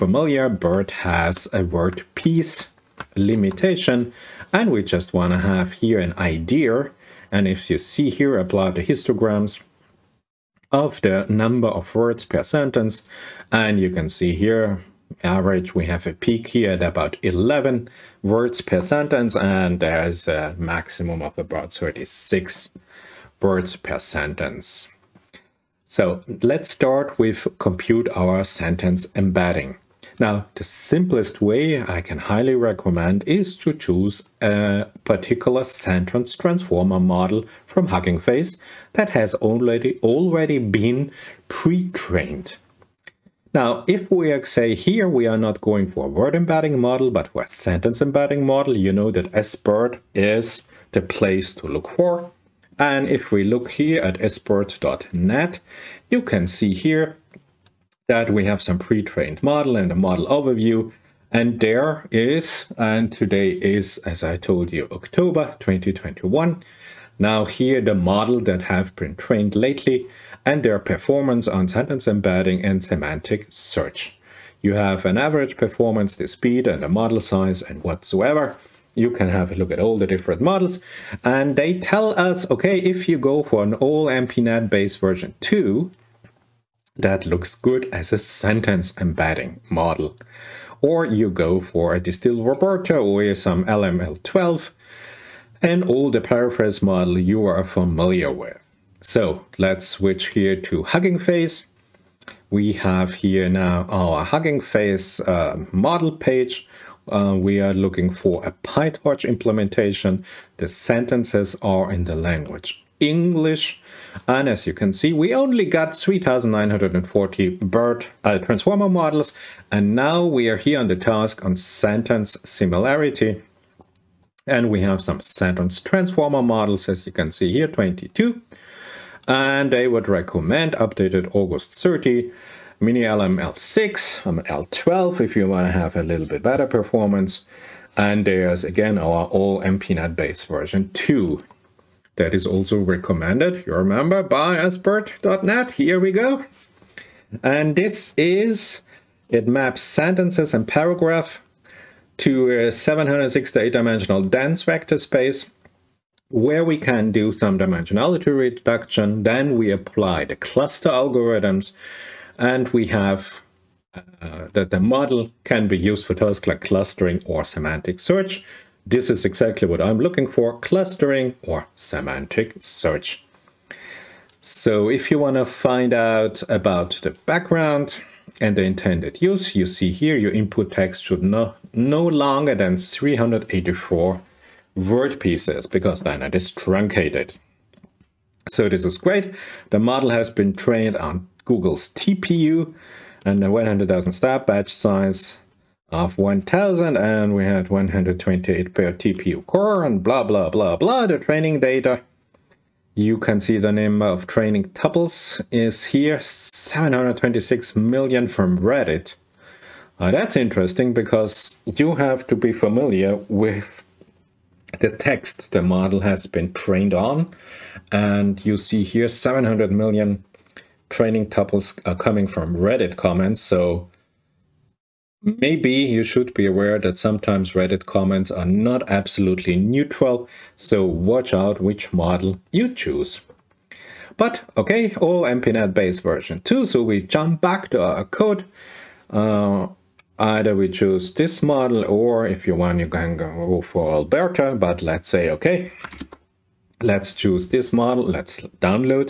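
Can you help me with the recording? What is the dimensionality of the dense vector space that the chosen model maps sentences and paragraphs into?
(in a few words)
768.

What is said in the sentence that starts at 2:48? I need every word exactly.
This is exactly what I'm looking for, clustering or semantic search.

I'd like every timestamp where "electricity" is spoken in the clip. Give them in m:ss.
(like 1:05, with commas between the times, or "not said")
not said.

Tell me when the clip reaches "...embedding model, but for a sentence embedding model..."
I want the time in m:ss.
0:46.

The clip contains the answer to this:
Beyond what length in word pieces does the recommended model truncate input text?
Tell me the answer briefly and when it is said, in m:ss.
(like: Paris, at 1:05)
384, at 3:02.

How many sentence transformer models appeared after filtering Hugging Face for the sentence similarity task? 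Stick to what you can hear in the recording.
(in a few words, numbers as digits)
22.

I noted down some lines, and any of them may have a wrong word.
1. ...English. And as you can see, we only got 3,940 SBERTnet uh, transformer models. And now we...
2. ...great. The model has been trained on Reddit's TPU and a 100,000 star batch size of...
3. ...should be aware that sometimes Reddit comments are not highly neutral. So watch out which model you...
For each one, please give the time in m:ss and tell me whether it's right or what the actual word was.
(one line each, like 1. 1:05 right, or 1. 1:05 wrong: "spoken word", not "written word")
1. 1:53 wrong: "BERT", not "SBERTnet"
2. 3:08 wrong: "Google", not "Reddit"
3. 3:46 wrong: "absolutely", not "highly".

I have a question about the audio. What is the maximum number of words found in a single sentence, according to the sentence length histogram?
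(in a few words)
36.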